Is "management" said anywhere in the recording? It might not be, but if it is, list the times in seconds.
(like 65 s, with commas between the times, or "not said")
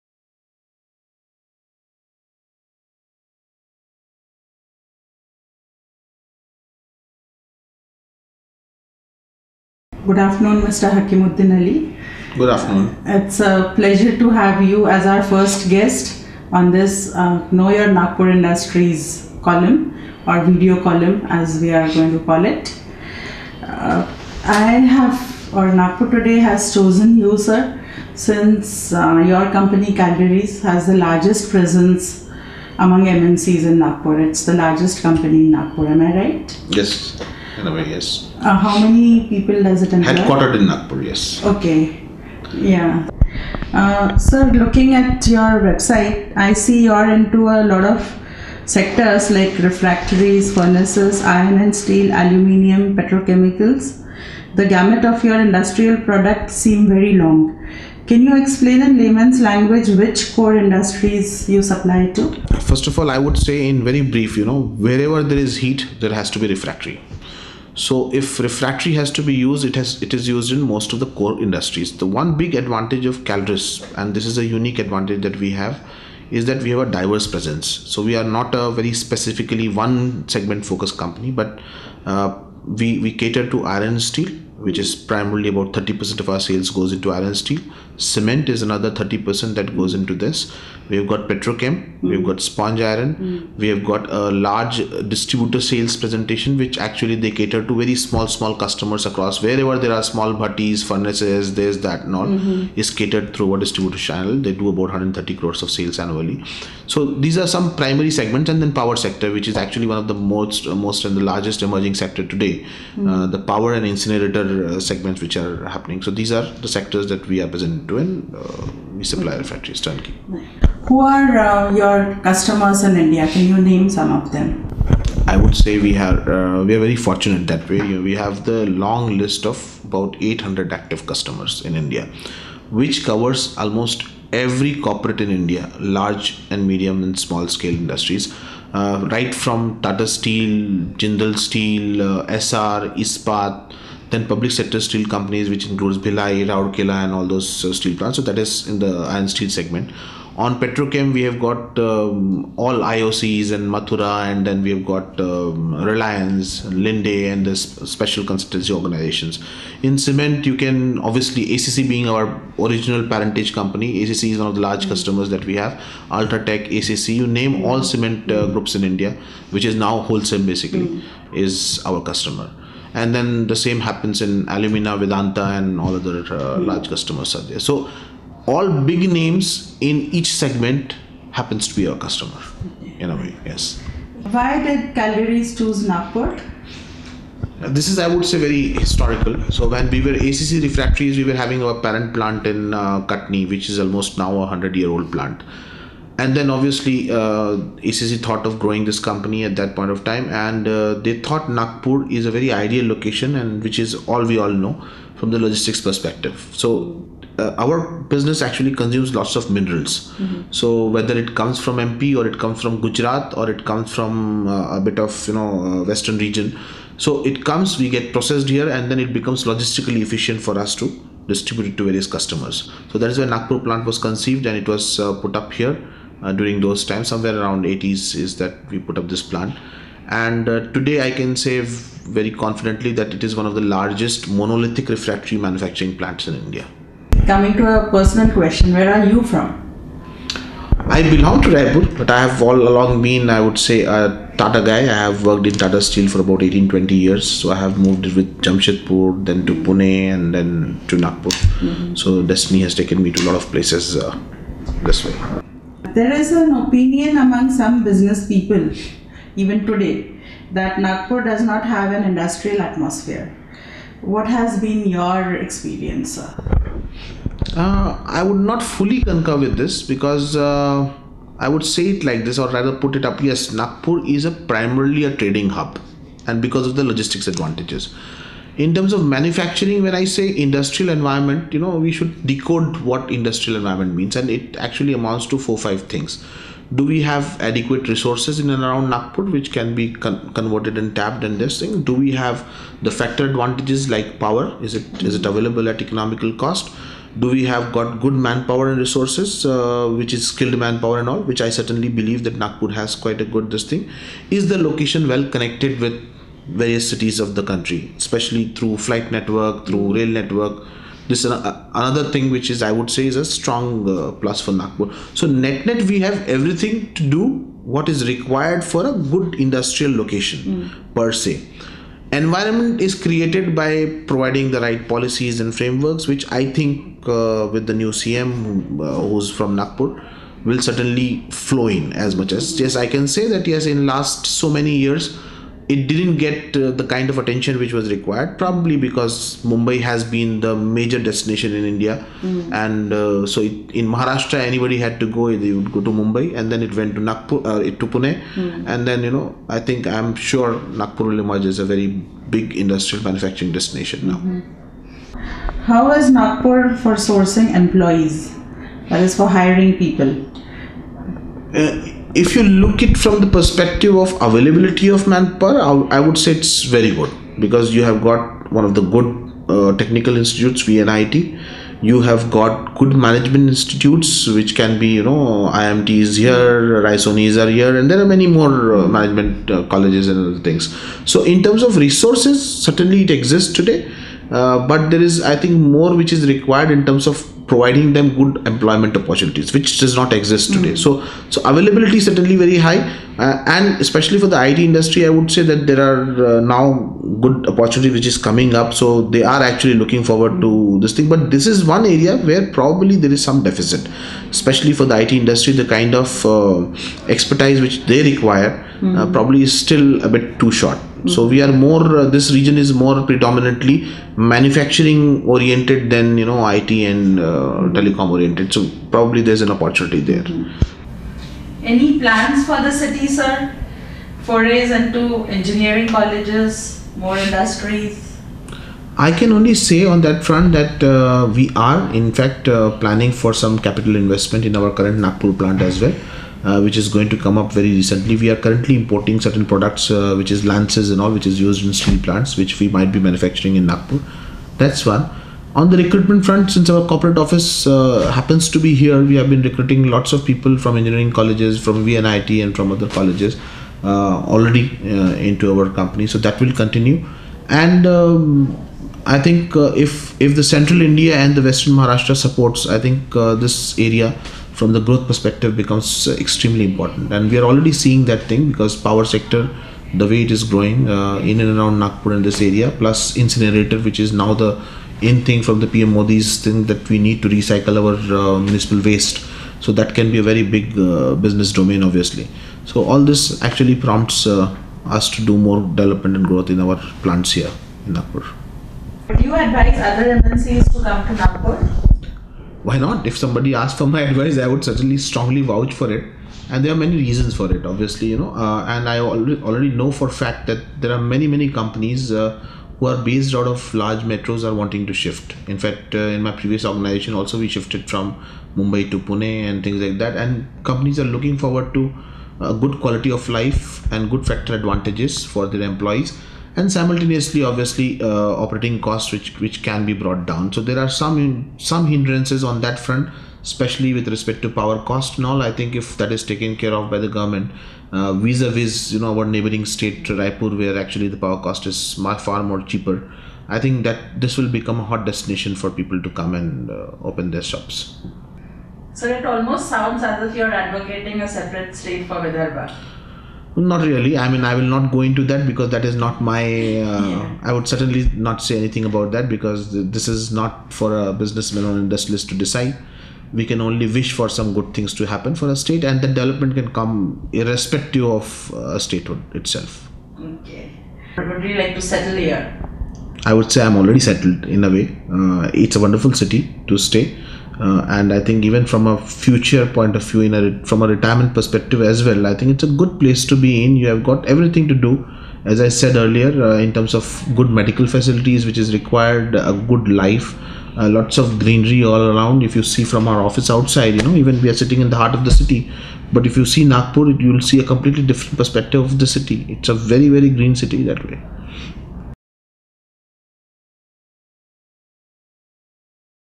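373 s, 378 s.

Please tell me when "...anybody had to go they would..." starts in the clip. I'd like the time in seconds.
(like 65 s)
344 s.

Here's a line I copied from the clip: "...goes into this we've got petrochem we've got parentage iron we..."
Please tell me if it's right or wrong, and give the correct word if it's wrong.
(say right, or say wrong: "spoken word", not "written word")
wrong: "sponge", not "parentage".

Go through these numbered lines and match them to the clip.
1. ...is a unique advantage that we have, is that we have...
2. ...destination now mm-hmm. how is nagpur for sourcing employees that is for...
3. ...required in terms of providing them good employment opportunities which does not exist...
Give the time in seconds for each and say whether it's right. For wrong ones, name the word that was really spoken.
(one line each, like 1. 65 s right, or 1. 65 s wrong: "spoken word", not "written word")
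1. 74 s right
2. 353 s right
3. 386 s right.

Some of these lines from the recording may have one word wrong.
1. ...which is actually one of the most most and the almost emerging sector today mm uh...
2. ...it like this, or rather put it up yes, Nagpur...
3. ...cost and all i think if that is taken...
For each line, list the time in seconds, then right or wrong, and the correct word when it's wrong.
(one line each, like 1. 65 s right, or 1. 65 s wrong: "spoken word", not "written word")
1. 109 s wrong: "largest", not "almost"
2. 271 s right
3. 524 s right.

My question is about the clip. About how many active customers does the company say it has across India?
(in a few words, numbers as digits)
800.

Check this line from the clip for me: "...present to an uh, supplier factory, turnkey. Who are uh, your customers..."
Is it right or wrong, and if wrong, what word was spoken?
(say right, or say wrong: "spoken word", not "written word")
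right.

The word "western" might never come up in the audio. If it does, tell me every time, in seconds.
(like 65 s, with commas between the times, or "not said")
215 s, 461 s.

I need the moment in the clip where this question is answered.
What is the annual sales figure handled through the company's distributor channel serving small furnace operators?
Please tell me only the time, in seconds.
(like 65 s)
104 s.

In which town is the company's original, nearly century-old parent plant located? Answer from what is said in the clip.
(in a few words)
Katni.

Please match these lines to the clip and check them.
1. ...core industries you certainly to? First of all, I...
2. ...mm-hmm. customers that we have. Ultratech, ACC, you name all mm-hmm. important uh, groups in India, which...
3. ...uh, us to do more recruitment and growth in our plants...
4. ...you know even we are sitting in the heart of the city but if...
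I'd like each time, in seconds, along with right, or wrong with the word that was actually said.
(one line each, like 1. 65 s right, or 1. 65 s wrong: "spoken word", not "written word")
1. 60 s wrong: "supply", not "certainly"
2. 164 s wrong: "cement", not "important"
3. 484 s wrong: "development", not "recruitment"
4. 583 s right.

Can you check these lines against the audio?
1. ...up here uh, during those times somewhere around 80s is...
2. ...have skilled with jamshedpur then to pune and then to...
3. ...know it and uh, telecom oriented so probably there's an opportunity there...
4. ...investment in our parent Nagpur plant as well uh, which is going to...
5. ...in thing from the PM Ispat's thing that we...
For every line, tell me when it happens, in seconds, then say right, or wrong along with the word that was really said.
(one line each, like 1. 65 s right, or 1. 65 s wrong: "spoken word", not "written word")
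1. 225 s right
2. 247 s wrong: "moved", not "skilled"
3. 416 s right
4. 433 s wrong: "current", not "parent"
5. 475 s wrong: "Modi", not "Ispat".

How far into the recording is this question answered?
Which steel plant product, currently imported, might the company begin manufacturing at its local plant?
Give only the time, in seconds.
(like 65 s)
440 s.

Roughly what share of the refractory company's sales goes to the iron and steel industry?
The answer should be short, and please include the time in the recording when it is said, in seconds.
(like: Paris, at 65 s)
30%, at 85 s.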